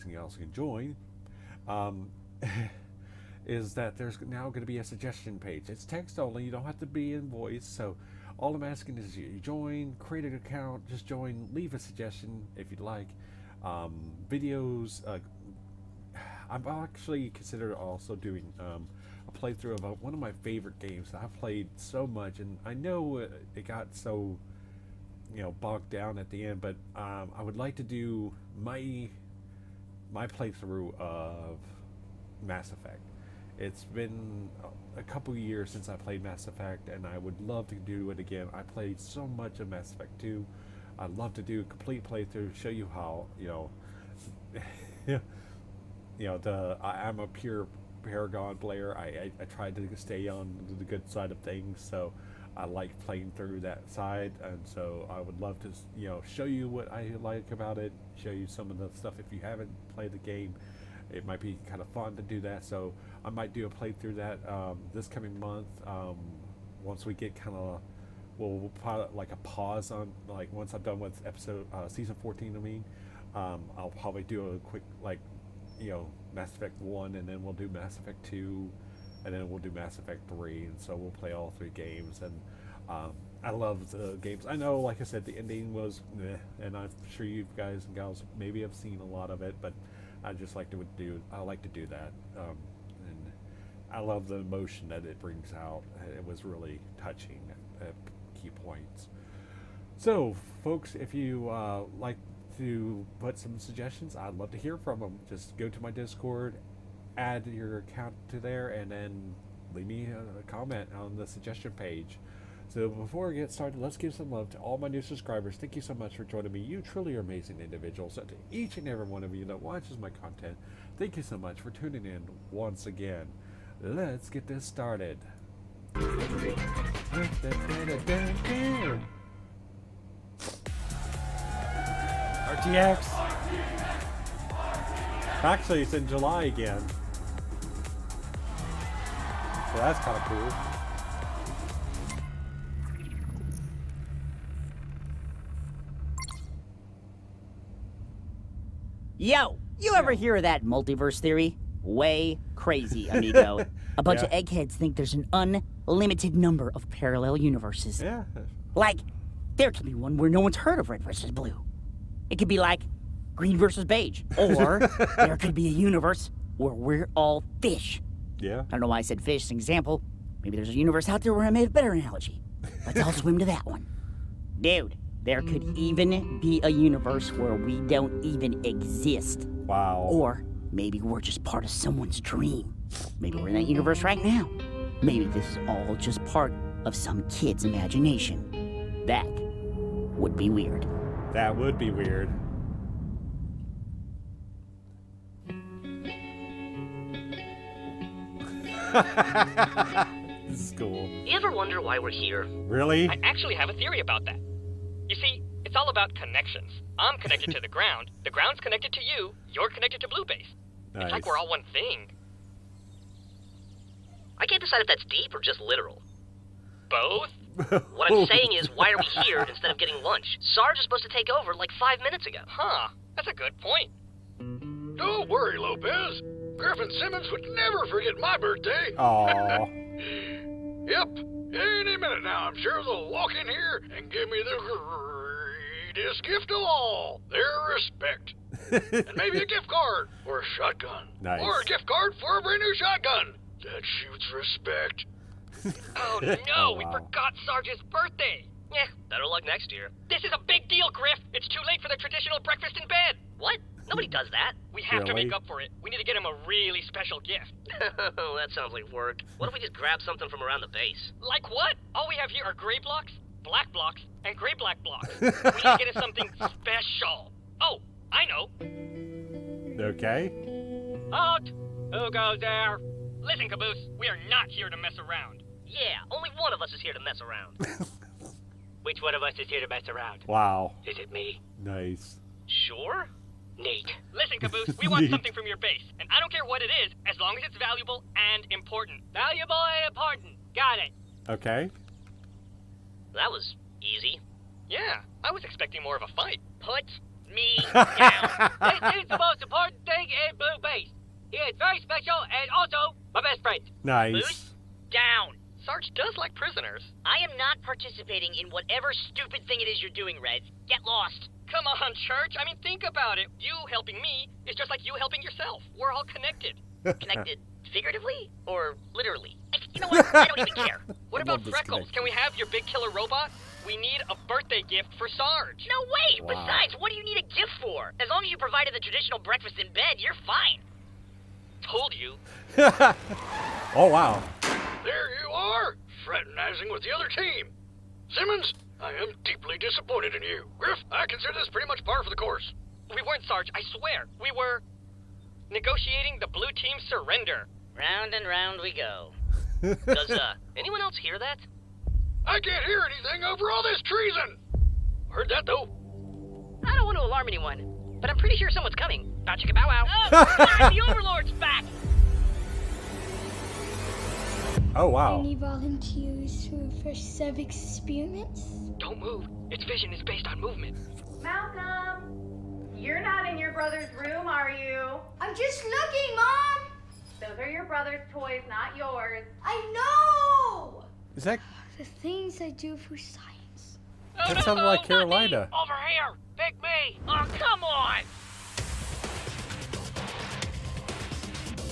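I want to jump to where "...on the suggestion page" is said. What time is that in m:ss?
1:50.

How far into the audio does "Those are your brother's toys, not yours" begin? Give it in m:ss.
6:17.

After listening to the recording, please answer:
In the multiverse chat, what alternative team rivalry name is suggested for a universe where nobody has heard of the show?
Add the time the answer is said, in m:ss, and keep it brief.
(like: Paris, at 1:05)
green versus beige, at 2:43.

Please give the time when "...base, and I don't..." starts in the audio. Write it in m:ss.
4:45.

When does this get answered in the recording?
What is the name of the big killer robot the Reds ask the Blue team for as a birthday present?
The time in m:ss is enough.
5:21.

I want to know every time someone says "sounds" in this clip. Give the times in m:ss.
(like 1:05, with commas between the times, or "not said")
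4:18, 6:24.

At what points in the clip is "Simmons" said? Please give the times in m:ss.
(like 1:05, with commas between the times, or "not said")
3:46, 5:38.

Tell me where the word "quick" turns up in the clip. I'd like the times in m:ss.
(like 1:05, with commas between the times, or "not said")
1:14.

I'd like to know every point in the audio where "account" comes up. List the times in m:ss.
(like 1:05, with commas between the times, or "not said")
0:10, 1:47.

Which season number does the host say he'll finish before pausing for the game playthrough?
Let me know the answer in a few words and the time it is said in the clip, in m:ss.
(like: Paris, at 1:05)
14, at 1:11.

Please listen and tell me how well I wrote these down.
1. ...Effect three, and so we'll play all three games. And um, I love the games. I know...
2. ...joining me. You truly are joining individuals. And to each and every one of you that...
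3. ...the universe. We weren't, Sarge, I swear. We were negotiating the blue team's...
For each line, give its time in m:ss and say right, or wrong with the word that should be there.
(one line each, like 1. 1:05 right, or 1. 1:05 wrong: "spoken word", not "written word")
1. 1:19 right
2. 1:56 wrong: "amazing", not "joining"
3. 5:42 wrong: "course", not "universe".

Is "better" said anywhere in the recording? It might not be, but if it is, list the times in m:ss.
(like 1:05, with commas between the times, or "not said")
2:51, 4:09.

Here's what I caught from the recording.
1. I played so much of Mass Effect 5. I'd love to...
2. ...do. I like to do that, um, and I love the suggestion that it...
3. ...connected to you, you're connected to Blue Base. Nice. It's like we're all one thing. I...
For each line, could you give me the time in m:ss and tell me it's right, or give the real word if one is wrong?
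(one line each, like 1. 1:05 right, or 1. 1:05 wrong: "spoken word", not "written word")
1. 0:38 wrong: "2", not "5"
2. 1:30 wrong: "emotion", not "suggestion"
3. 3:28 right.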